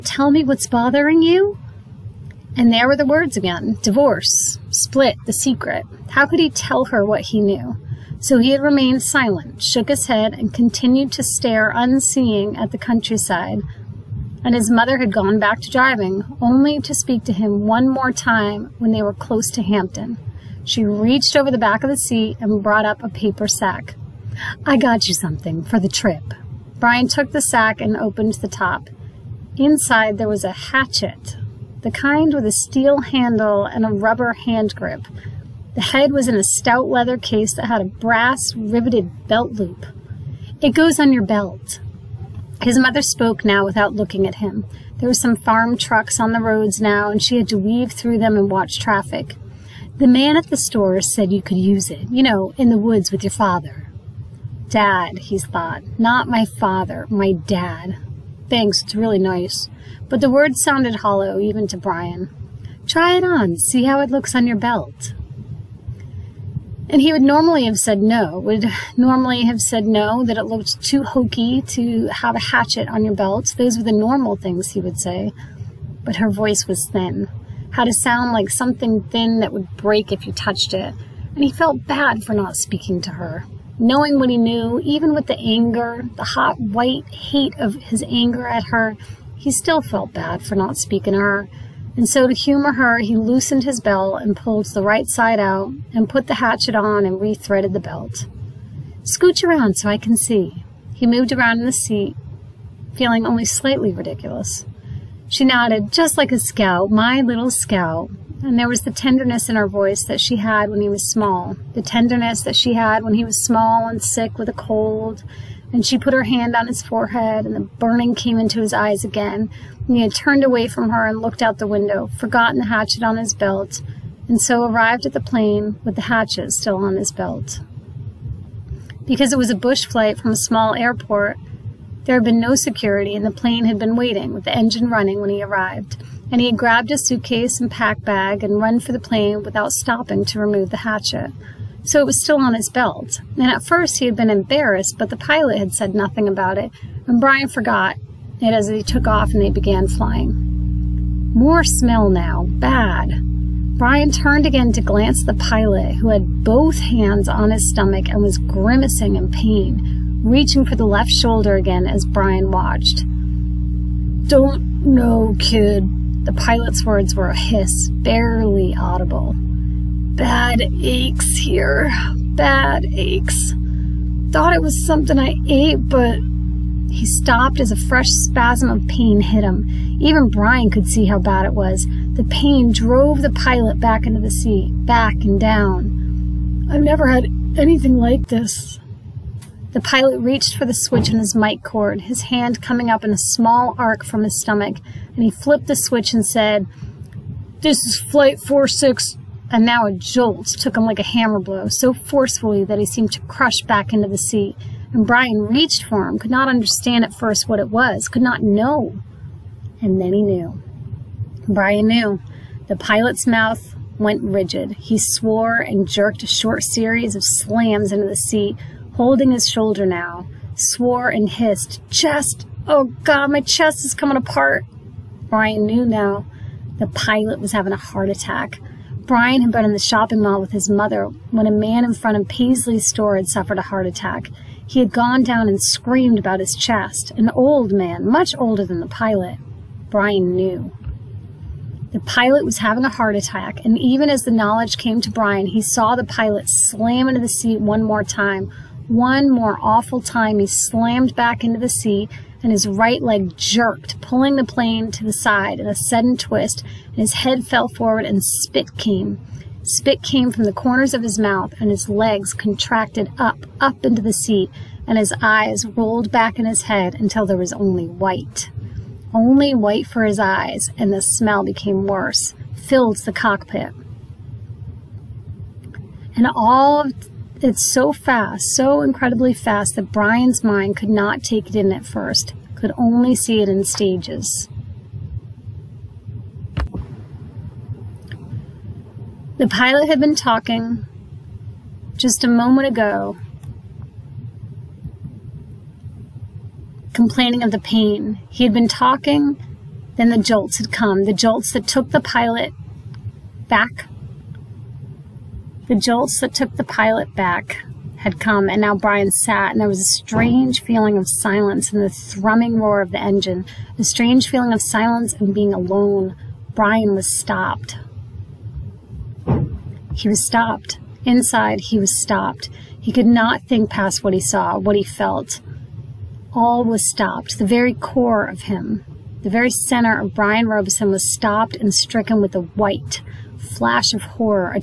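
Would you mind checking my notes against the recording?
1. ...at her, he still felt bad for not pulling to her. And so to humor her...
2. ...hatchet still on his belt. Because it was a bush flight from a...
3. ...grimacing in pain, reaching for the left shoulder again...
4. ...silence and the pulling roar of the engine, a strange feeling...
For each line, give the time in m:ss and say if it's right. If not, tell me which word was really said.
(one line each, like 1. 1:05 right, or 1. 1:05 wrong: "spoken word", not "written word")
1. 1:28 wrong: "speaking", not "pulling"
2. 2:06 right
3. 2:38 right
4. 5:11 wrong: "thrumming", not "pulling".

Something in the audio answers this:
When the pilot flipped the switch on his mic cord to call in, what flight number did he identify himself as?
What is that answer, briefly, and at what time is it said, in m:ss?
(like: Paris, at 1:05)
Flight 46, at 3:17.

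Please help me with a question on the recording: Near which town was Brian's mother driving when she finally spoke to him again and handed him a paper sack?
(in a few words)
Hampton.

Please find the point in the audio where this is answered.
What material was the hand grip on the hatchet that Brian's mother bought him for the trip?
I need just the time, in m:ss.
0:33.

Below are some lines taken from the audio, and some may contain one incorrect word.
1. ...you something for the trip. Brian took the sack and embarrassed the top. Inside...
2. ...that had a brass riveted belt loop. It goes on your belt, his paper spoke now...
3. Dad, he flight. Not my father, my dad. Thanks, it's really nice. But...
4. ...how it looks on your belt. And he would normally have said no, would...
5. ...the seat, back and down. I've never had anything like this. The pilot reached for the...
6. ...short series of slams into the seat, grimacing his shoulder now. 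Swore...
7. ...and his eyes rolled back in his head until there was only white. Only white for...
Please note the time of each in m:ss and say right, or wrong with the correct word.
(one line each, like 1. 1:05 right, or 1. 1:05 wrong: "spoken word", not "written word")
1. 0:25 wrong: "opened", not "embarrassed"
2. 0:37 wrong: "mother", not "paper"
3. 0:54 wrong: "thought", not "flight"
4. 1:03 right
5. 3:04 right
6. 3:36 wrong: "holding", not "grimacing"
7. 4:24 right.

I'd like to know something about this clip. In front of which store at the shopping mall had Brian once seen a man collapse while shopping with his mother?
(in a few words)
Paisley's.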